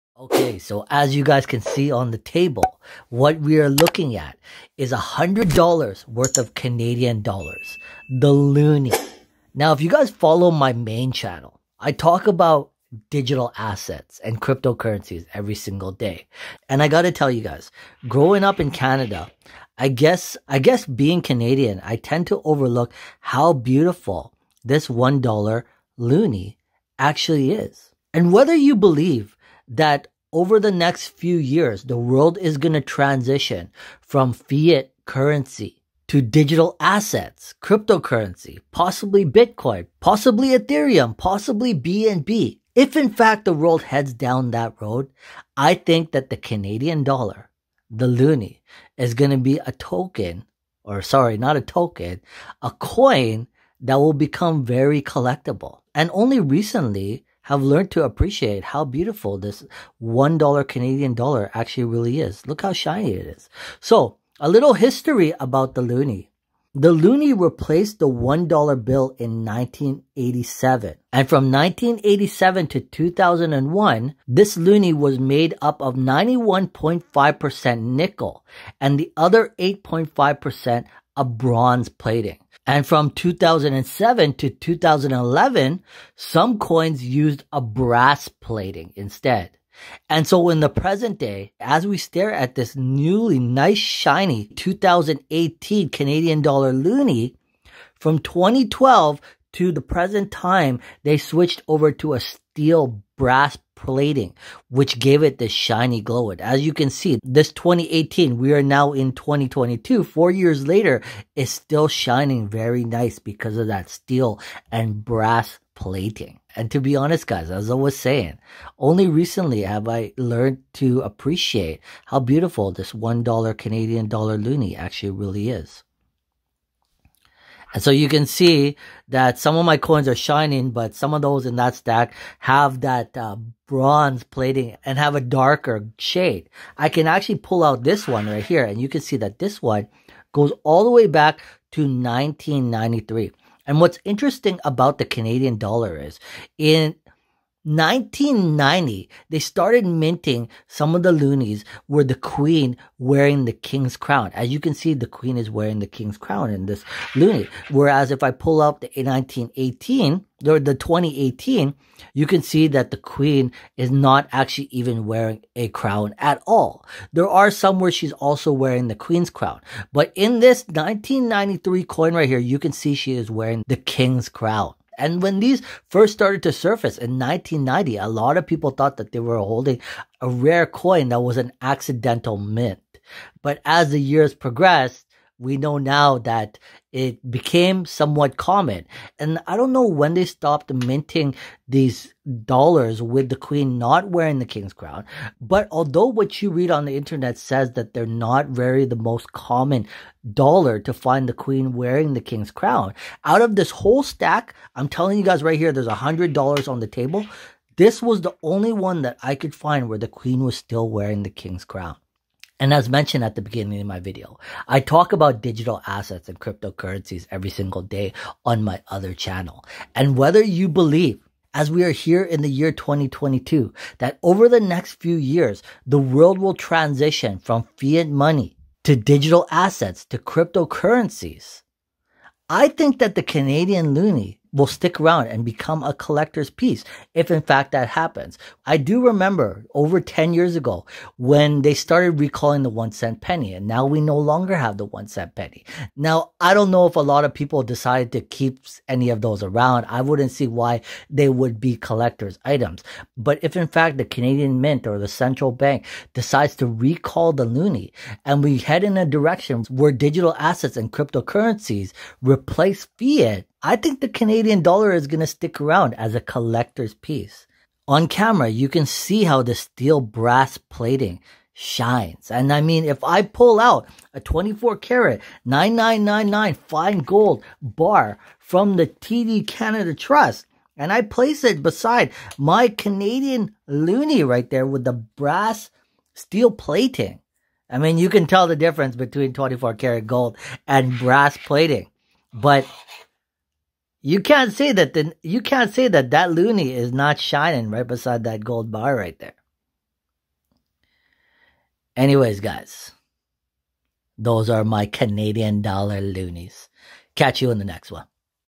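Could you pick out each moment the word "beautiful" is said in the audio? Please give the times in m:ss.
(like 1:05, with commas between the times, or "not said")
0:23, 0:58, 2:02.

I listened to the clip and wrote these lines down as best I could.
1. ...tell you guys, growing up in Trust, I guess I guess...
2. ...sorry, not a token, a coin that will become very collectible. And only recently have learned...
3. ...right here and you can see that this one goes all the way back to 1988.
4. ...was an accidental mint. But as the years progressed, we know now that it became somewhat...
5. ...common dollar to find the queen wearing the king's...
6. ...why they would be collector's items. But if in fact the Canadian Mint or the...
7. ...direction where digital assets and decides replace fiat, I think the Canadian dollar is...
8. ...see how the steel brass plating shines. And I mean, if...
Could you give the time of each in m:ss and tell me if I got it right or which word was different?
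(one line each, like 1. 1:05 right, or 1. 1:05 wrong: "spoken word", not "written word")
1. 0:17 wrong: "Canada", not "Trust"
2. 0:51 right
3. 2:18 wrong: "1993", not "1988"
4. 3:01 right
5. 3:19 right
6. 4:10 right
7. 4:19 wrong: "cryptocurrencies", not "decides"
8. 4:28 right.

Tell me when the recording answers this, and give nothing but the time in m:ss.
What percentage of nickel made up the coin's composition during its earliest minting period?
1:15.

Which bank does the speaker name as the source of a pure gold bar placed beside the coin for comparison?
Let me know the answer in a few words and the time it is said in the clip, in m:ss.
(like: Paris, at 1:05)
TD Canada Trust, at 4:38.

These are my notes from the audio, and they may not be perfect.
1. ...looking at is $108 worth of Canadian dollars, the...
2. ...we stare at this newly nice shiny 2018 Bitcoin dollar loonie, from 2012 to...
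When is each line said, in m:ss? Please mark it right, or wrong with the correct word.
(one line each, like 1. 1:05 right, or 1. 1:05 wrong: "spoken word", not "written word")
1. 0:03 wrong: "100", not "108"
2. 1:31 wrong: "Canadian", not "Bitcoin".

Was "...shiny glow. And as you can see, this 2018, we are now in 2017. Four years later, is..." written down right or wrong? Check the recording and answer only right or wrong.
wrong.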